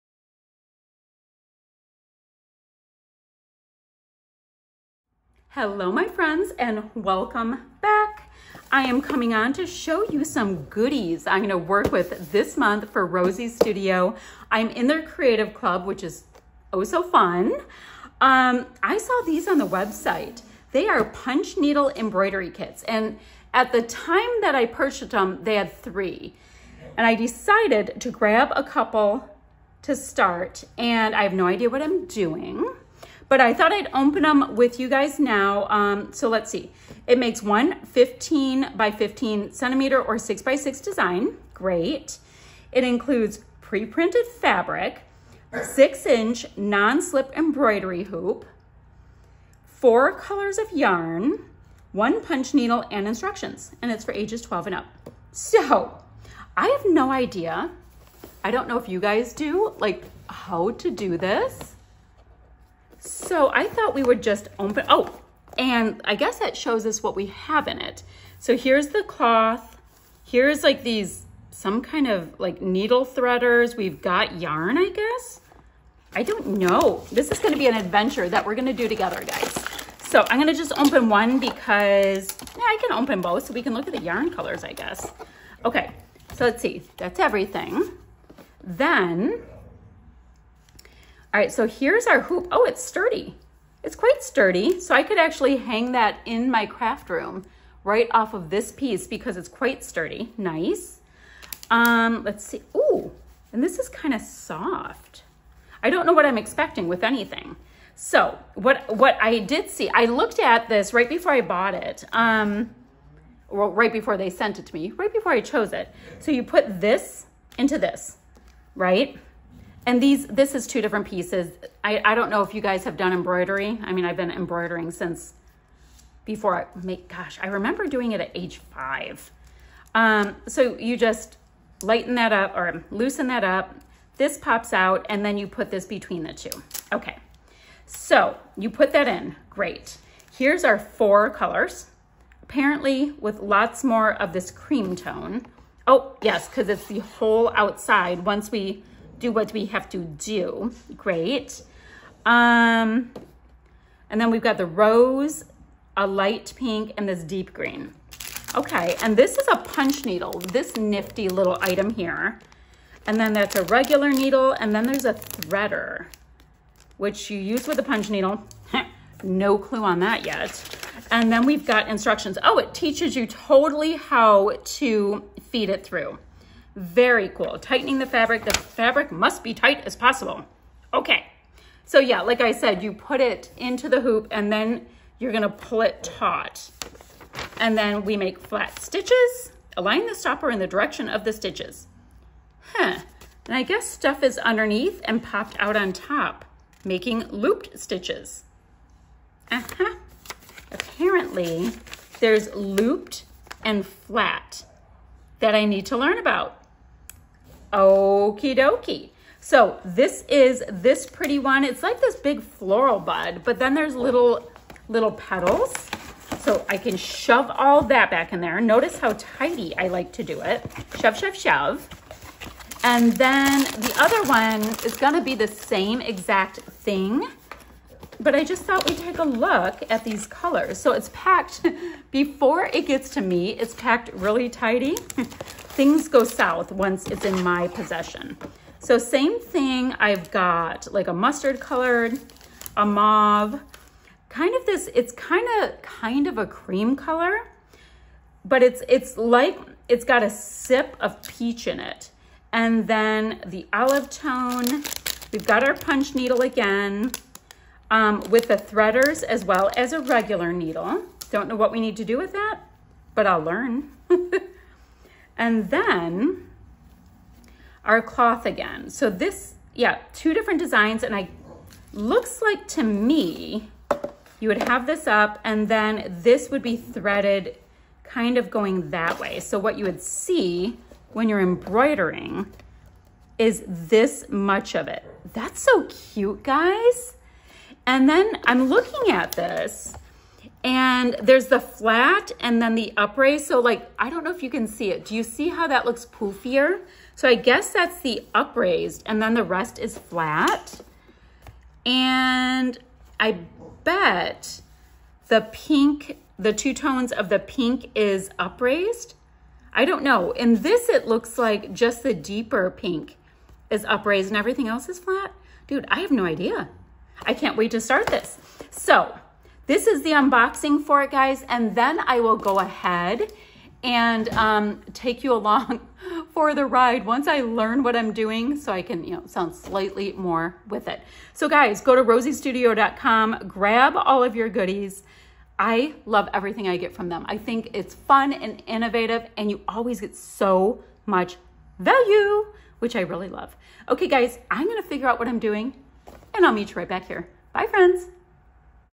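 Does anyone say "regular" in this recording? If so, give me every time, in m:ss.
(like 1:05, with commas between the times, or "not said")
2:43, 4:20.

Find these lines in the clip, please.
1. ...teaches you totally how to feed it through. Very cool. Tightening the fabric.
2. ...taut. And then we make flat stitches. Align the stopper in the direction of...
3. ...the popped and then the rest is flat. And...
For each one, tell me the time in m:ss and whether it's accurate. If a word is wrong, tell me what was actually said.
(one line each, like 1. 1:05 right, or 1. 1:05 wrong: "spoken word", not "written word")
1. 2:52 right
2. 3:06 right
3. 4:58 wrong: "upraised", not "popped".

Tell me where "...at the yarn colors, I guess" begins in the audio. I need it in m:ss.
1:23.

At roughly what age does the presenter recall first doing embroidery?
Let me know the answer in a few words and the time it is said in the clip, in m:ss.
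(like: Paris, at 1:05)
5, at 2:08.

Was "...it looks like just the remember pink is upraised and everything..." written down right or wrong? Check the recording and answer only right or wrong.
wrong.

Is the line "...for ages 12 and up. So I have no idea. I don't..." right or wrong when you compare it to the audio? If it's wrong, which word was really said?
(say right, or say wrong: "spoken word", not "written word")
right.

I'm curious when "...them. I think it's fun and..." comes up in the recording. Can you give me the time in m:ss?
5:37.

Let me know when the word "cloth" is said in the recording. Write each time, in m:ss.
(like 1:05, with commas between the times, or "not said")
1:09, 4:28.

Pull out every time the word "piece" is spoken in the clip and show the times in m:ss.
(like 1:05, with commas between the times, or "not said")
1:38, 2:01.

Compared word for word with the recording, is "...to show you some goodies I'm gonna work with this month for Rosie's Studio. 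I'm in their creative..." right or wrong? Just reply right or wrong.
right.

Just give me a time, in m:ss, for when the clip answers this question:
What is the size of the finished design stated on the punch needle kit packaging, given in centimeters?
0:37.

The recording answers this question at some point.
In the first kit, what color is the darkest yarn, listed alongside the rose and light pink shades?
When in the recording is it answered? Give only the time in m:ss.
2:37.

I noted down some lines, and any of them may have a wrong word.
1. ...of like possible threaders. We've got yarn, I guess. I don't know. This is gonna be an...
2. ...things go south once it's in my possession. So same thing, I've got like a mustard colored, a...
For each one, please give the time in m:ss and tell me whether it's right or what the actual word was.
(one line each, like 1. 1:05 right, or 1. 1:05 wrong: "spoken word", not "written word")
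1. 1:12 wrong: "needle", not "possible"
2. 3:55 right.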